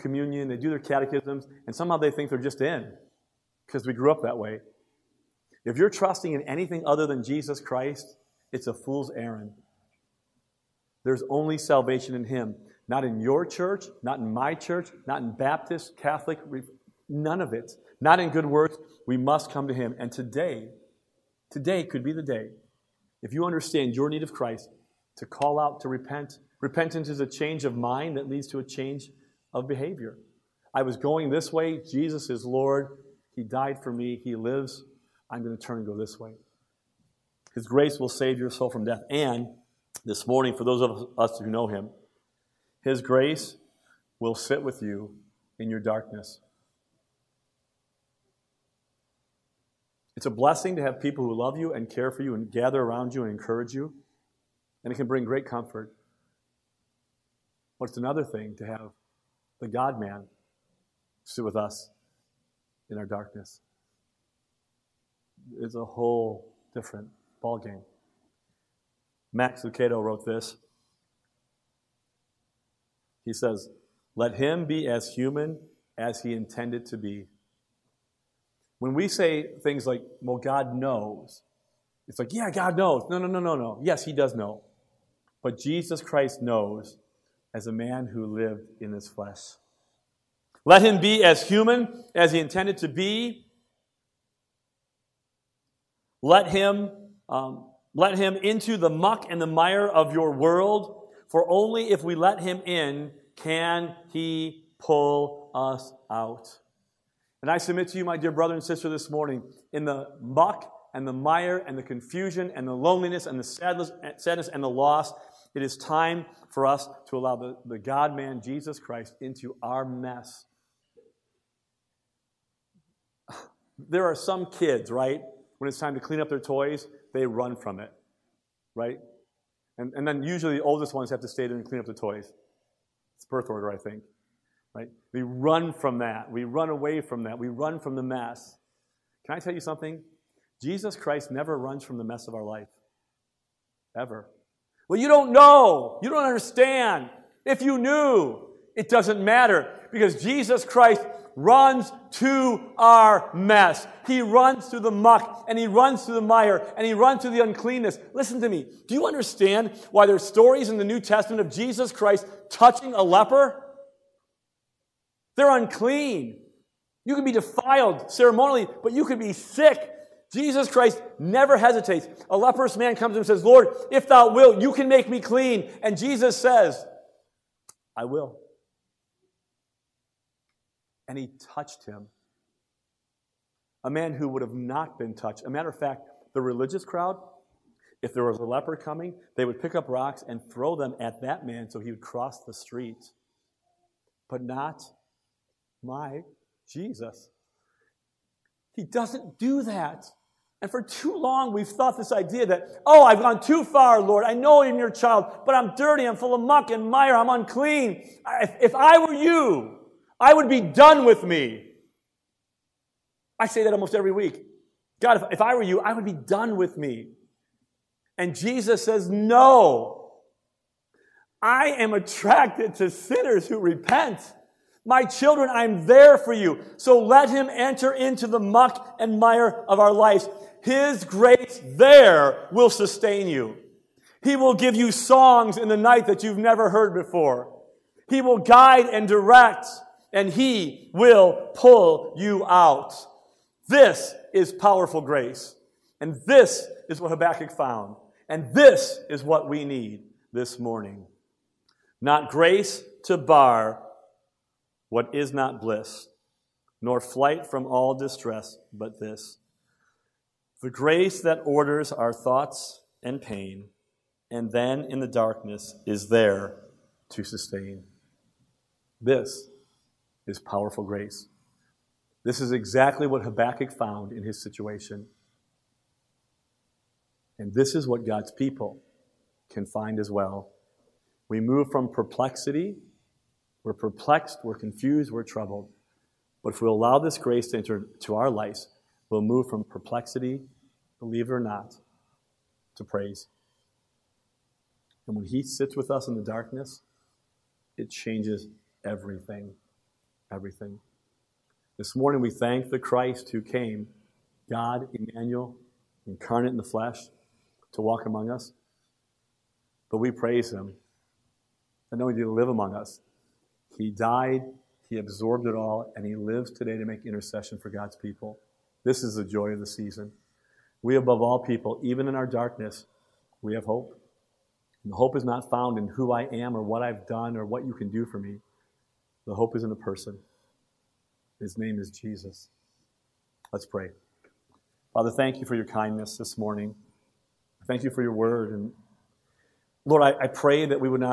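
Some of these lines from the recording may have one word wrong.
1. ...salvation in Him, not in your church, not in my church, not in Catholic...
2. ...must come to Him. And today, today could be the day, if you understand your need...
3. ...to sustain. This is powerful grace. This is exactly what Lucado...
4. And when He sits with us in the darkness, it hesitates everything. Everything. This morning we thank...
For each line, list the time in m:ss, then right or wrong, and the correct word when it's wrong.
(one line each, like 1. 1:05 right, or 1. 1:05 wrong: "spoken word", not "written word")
1. 0:11 wrong: "Baptist", not "Catholic"
2. 0:19 right
3. 4:27 wrong: "Habakkuk", not "Lucado"
4. 4:55 wrong: "changes", not "hesitates".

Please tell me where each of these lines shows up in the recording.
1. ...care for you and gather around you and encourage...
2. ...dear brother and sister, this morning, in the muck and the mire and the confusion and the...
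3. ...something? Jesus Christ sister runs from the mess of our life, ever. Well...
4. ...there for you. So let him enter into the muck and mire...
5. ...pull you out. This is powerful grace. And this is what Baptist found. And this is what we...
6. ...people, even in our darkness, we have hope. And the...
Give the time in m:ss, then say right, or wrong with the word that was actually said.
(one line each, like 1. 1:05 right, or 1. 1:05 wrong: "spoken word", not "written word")
1. 0:51 right
2. 1:48 right
3. 2:19 wrong: "never", not "sister"
4. 3:45 right
5. 4:01 wrong: "Habakkuk", not "Baptist"
6. 5:21 right.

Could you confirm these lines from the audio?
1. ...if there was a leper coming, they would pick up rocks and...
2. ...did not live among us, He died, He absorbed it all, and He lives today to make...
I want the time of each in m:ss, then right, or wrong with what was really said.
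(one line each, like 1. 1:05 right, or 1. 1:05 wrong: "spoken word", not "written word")
1. 3:08 right
2. 5:12 right.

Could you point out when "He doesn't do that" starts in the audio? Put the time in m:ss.
3:18.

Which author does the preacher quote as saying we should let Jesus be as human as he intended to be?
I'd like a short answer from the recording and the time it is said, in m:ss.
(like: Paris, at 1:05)
Max Lucado, at 1:09.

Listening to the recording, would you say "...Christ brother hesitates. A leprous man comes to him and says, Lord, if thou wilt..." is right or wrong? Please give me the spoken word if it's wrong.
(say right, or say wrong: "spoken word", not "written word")
wrong: "never", not "brother".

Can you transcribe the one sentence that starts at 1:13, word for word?
He says, Let him be as human as he intended to be.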